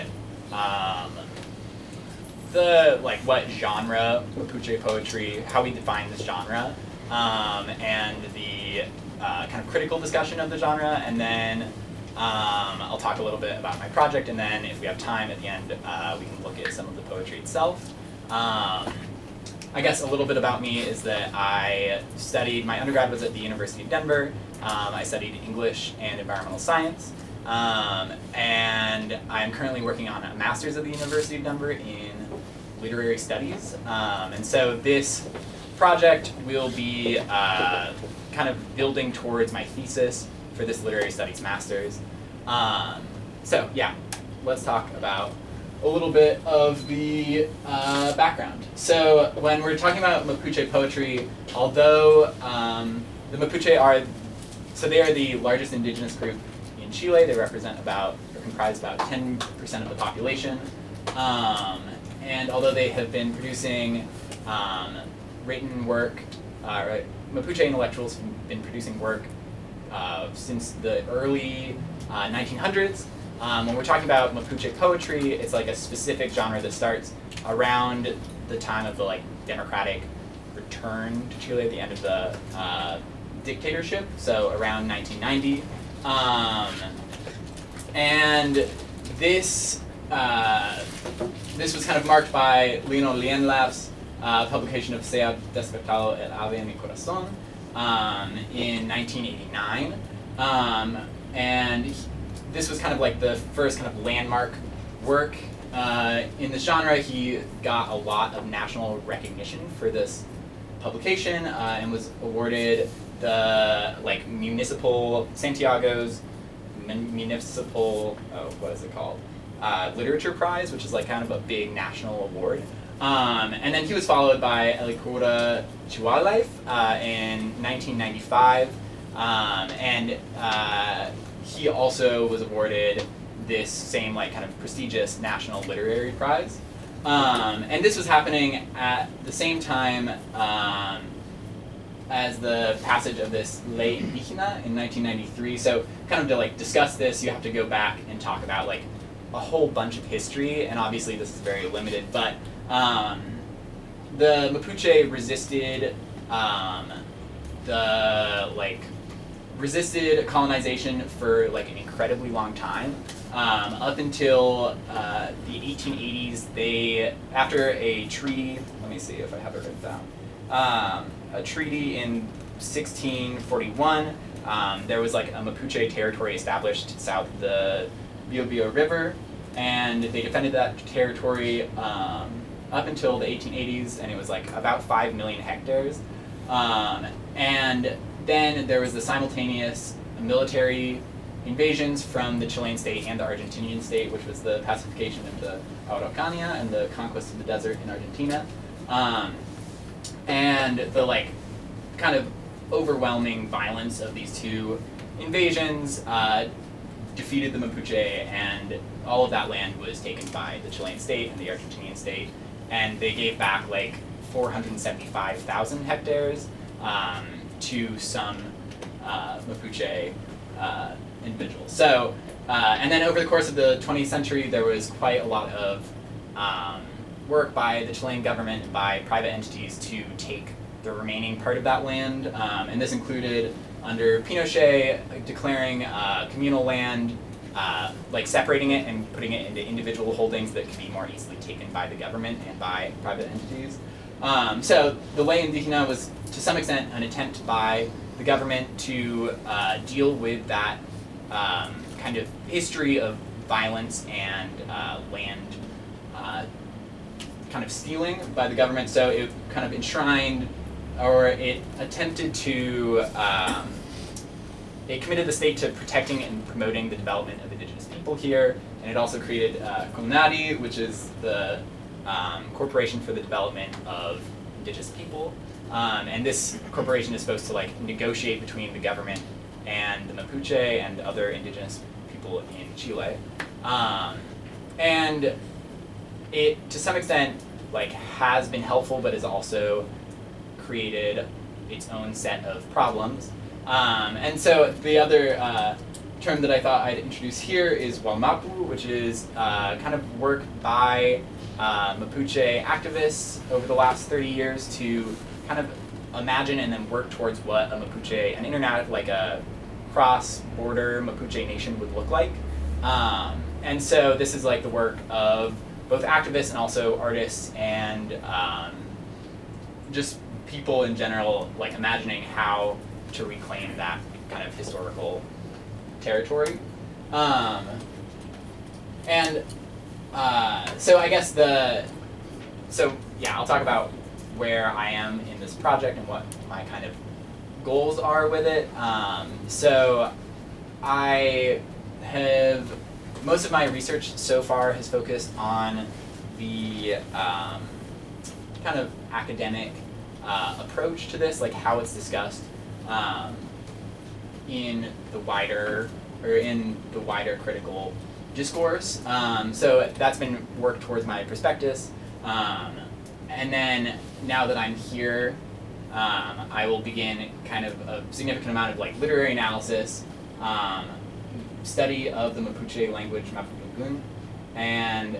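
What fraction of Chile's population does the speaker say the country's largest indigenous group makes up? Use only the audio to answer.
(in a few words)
10%.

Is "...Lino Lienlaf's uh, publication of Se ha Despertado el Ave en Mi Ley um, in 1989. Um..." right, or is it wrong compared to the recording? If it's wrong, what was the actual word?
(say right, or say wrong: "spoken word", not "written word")
wrong: "Corazón", not "Ley".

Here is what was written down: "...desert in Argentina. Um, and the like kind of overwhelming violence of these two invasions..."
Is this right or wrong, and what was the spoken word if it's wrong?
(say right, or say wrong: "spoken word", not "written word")
right.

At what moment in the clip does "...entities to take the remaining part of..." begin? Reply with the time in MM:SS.
03:49.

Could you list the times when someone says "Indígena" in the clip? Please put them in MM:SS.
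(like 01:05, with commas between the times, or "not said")
02:23, 04:05.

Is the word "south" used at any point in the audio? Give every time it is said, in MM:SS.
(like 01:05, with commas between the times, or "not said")
02:57.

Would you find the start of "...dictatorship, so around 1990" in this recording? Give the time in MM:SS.
01:23.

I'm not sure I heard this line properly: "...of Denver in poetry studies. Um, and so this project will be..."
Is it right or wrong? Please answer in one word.
wrong.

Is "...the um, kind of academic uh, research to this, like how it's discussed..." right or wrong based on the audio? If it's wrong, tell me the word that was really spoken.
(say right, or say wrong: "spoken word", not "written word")
wrong: "approach", not "research".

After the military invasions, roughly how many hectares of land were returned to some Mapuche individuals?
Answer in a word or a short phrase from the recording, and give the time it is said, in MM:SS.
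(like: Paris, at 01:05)
475,000 hectares, at 03:34.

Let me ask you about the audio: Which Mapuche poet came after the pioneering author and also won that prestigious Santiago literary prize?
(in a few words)
Elikura Chihuailaf.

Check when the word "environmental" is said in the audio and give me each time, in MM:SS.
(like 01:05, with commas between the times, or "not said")
00:26.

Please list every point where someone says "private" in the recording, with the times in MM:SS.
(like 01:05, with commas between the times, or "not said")
03:49, 04:03.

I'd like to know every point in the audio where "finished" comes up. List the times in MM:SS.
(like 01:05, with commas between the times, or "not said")
not said.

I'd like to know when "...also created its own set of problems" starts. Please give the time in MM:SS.
04:49.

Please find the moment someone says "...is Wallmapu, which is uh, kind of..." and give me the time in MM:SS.
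04:57.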